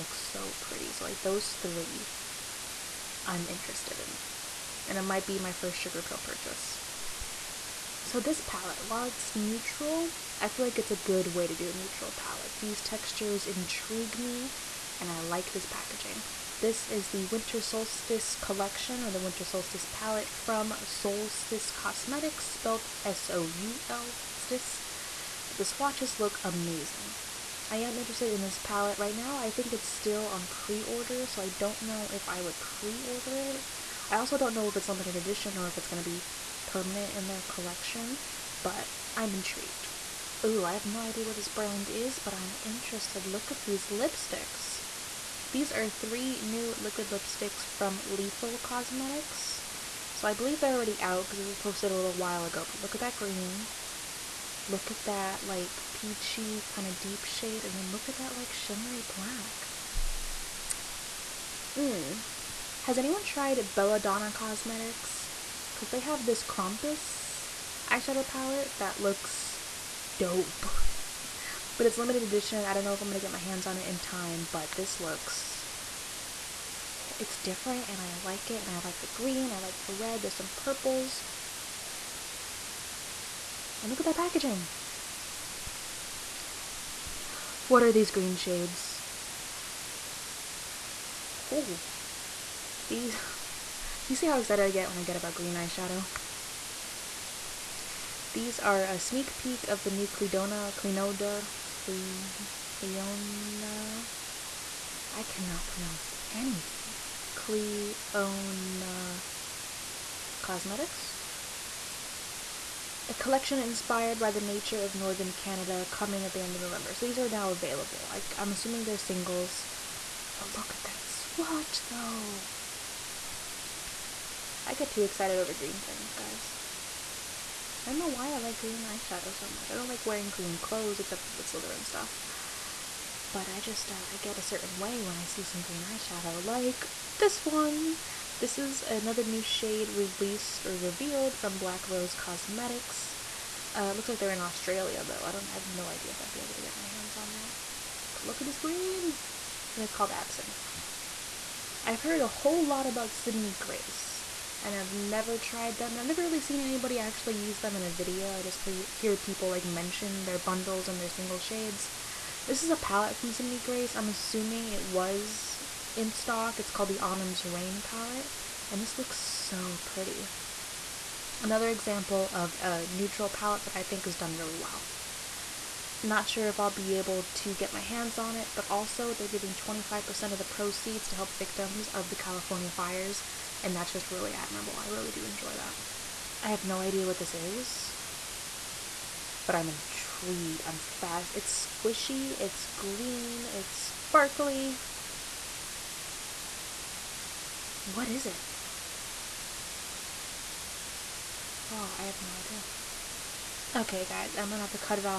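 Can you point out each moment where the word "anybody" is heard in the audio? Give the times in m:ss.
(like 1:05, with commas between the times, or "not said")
2:36.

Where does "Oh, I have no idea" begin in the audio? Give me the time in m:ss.
3:21.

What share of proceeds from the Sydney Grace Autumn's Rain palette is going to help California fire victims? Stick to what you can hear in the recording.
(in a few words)
25%.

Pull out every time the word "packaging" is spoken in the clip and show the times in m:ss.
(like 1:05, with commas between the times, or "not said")
0:15, 1:24.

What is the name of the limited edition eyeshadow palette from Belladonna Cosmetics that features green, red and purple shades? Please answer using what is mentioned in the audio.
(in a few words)
Krampus.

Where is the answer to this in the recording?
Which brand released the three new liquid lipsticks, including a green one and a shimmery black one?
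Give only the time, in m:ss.
0:48.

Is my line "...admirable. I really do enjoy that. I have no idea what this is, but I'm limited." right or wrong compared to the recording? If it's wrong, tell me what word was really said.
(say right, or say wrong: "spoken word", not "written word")
wrong: "intrigued", not "limited".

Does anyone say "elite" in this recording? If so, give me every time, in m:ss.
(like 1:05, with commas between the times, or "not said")
not said.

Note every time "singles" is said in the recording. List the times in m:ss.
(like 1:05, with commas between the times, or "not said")
1:58, 2:41.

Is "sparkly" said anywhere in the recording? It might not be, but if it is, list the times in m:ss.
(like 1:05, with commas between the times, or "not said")
3:13.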